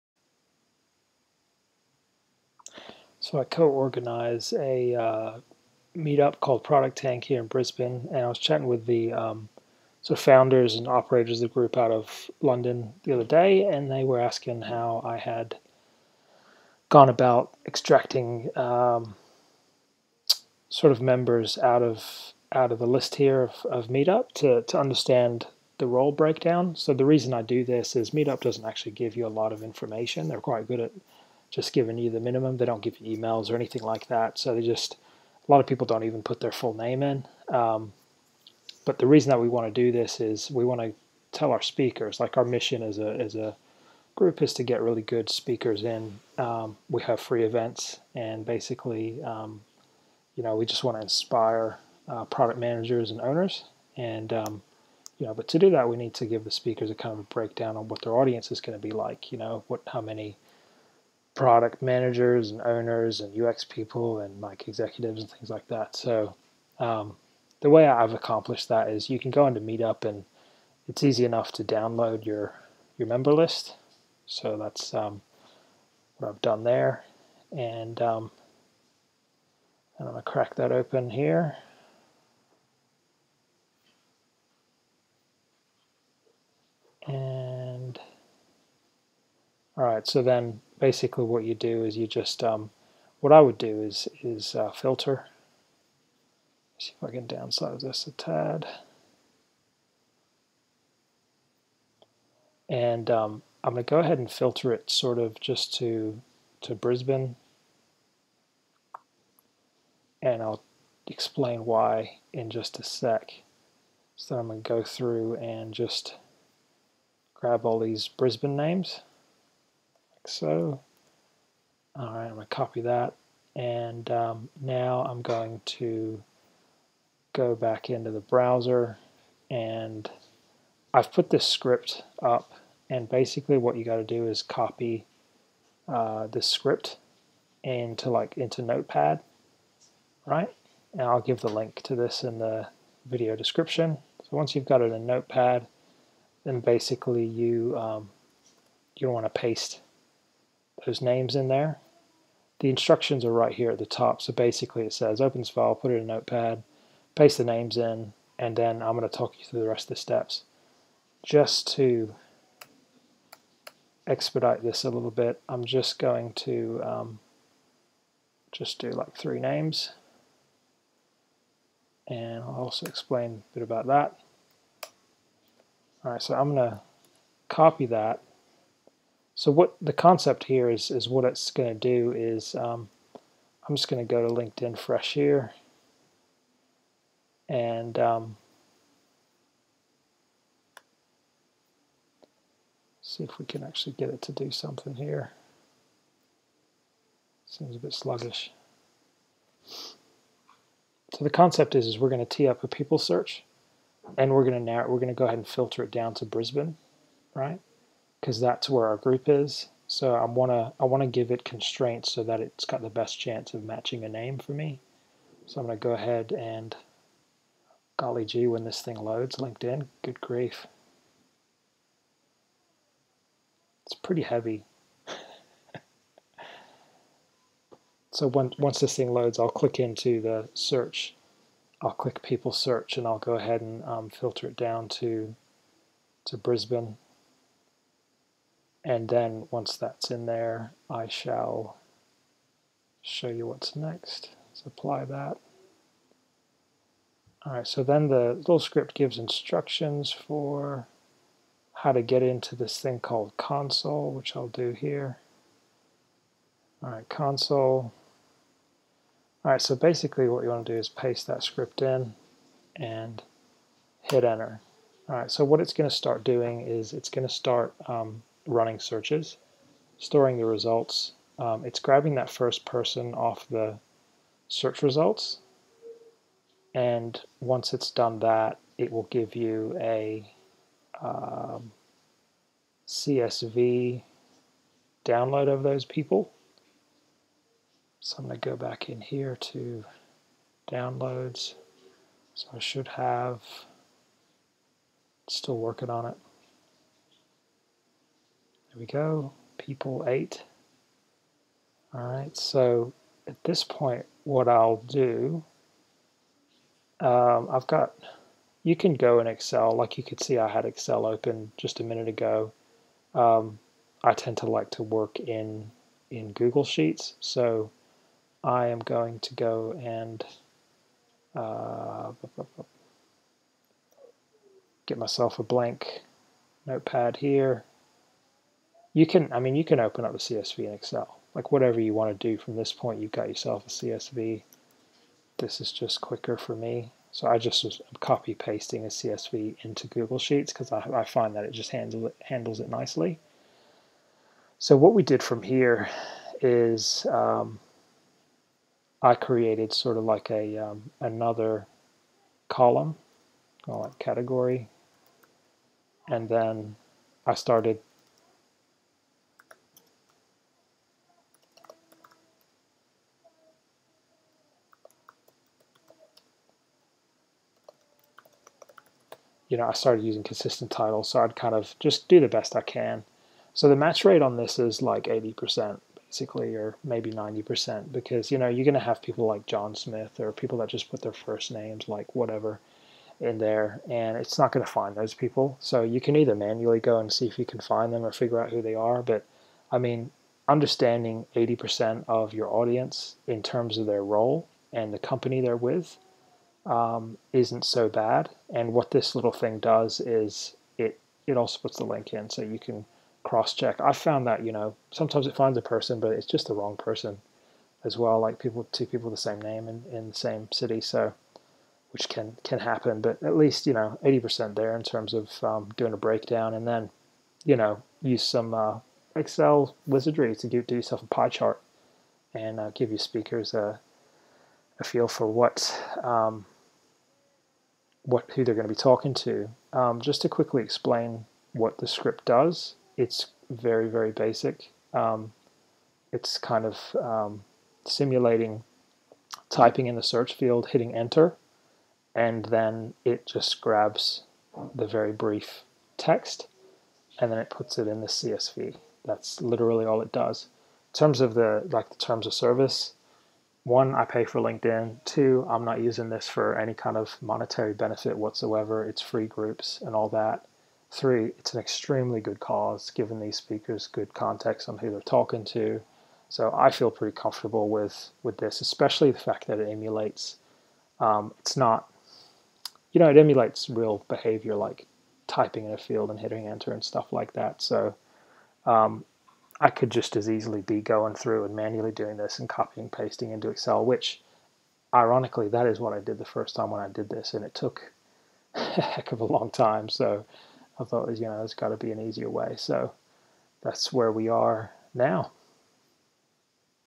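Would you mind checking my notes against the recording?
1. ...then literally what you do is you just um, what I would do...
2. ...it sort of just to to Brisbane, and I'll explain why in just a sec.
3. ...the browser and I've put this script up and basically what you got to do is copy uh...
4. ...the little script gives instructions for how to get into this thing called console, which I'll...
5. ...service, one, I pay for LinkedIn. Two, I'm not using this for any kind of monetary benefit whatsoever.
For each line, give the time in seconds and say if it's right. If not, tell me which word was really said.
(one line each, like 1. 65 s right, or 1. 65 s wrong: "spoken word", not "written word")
1. 90 s wrong: "basically", not "literally"
2. 104 s right
3. 128 s right
4. 248 s right
5. 452 s right.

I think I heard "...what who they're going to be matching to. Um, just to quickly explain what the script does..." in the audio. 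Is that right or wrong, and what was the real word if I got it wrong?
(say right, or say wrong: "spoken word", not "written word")
wrong: "talking", not "matching".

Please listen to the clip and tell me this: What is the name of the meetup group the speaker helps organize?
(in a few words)
Product Tank.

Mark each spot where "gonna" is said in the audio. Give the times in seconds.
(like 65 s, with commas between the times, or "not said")
80 s, 176 s.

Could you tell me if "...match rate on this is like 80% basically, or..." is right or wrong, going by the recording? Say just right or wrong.
right.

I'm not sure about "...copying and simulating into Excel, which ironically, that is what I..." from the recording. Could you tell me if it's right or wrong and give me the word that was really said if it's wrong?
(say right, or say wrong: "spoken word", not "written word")
wrong: "pasting", not "simulating".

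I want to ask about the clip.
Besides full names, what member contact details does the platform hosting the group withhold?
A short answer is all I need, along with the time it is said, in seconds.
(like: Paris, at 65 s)
emails, at 33 s.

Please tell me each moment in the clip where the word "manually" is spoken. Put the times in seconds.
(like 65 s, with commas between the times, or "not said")
386 s, 481 s.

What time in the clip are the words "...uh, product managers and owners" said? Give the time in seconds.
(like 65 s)
52 s.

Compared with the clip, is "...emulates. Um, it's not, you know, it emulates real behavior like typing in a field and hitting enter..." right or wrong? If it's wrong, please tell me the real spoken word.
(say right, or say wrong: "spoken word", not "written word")
right.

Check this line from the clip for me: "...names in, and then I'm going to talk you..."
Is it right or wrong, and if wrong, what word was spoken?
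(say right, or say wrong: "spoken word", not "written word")
right.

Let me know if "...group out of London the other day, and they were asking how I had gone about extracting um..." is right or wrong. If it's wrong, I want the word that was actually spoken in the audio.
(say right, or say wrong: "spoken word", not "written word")
right.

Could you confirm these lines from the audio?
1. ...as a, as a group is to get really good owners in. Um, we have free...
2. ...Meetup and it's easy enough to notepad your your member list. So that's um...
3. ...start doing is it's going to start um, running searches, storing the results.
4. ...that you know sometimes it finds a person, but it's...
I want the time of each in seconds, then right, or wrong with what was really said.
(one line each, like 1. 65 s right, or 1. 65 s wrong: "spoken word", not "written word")
1. 42 s wrong: "speakers", not "owners"
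2. 69 s wrong: "download", not "notepad"
3. 265 s right
4. 404 s right.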